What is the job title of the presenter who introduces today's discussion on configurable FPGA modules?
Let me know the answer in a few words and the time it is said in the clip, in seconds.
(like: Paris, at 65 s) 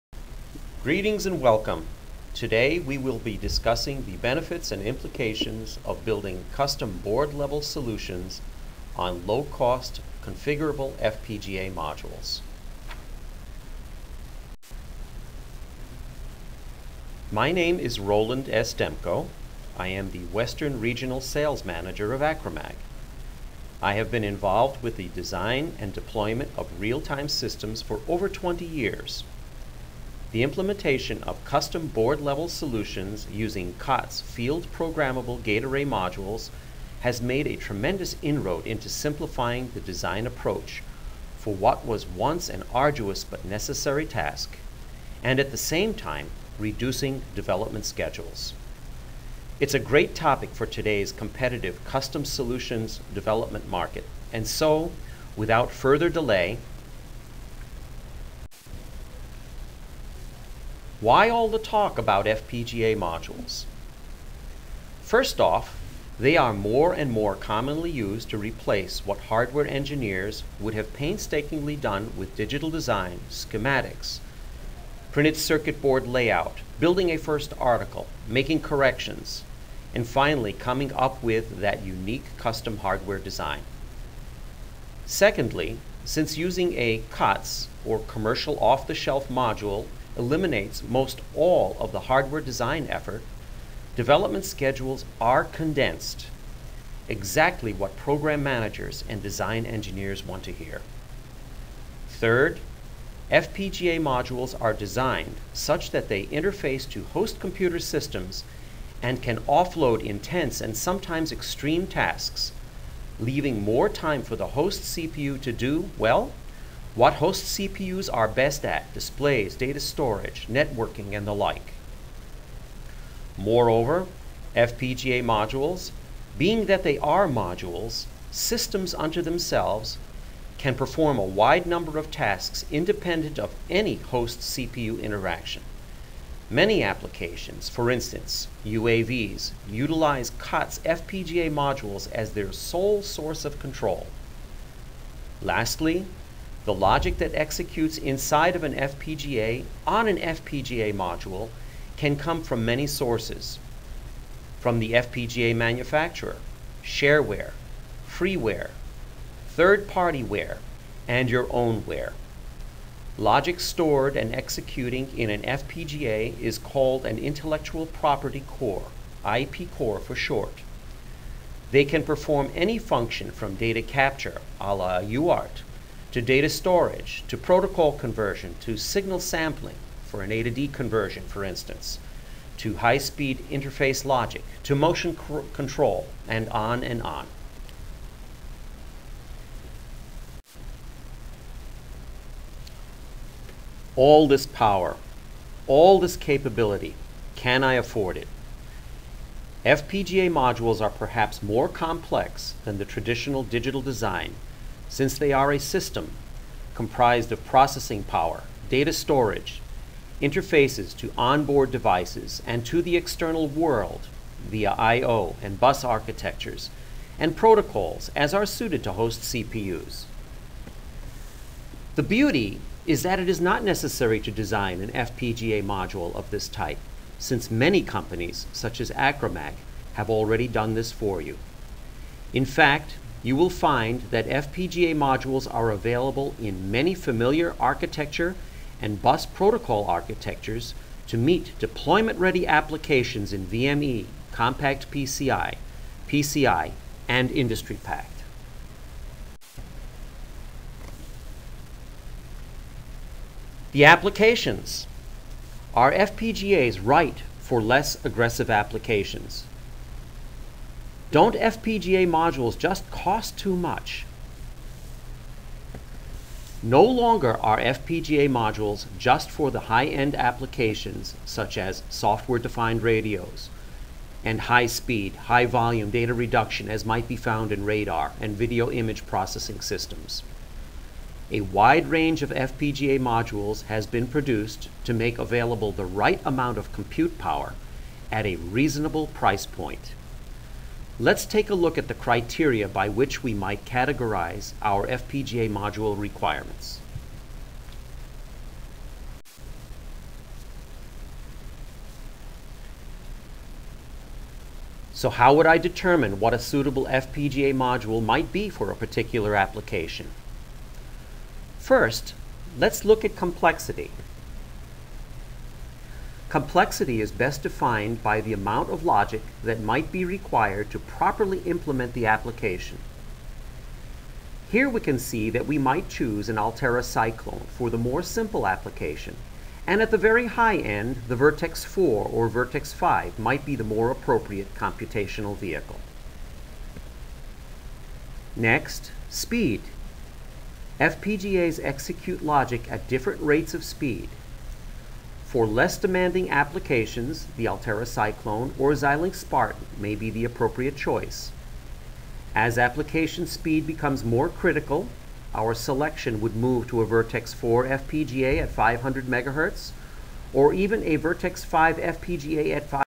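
Western Regional Sales Manager, at 20 s.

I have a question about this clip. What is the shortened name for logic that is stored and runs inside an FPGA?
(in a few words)
IP core.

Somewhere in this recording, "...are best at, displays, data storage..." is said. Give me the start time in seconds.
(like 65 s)
118 s.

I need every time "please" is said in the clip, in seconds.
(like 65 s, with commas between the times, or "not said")
not said.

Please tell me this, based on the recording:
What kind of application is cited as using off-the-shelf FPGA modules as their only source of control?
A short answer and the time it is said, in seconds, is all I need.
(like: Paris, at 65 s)
UAVs, at 138 s.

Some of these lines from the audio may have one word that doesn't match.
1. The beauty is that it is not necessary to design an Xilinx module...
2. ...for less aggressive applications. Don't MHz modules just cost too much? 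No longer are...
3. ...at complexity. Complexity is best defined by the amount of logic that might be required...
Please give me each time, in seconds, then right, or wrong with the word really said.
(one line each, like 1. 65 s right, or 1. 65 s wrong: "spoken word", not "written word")
1. 221 s wrong: "FPGA", not "Xilinx"
2. 257 s wrong: "FPGA", not "MHz"
3. 313 s right.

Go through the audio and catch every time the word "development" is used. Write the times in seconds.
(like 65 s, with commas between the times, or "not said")
47 s, 53 s, 93 s.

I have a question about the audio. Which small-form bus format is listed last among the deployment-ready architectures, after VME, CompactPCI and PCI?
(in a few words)
IndustryPack.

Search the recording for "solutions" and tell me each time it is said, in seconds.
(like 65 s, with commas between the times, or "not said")
7 s, 32 s, 52 s.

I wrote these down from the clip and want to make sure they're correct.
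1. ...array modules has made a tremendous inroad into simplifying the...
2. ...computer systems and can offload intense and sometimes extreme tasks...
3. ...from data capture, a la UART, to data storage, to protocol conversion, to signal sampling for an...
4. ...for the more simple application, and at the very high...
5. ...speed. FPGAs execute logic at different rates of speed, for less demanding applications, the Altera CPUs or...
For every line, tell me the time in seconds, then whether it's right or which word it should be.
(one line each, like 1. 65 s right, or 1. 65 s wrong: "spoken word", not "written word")
1. 35 s right
2. 107 s right
3. 173 s right
4. 327 s right
5. 339 s wrong: "Cyclone", not "CPUs".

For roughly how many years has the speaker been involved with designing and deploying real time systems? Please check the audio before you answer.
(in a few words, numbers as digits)
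over 20 years.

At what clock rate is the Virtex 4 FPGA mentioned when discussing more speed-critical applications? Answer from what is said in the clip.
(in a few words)
500 MHz.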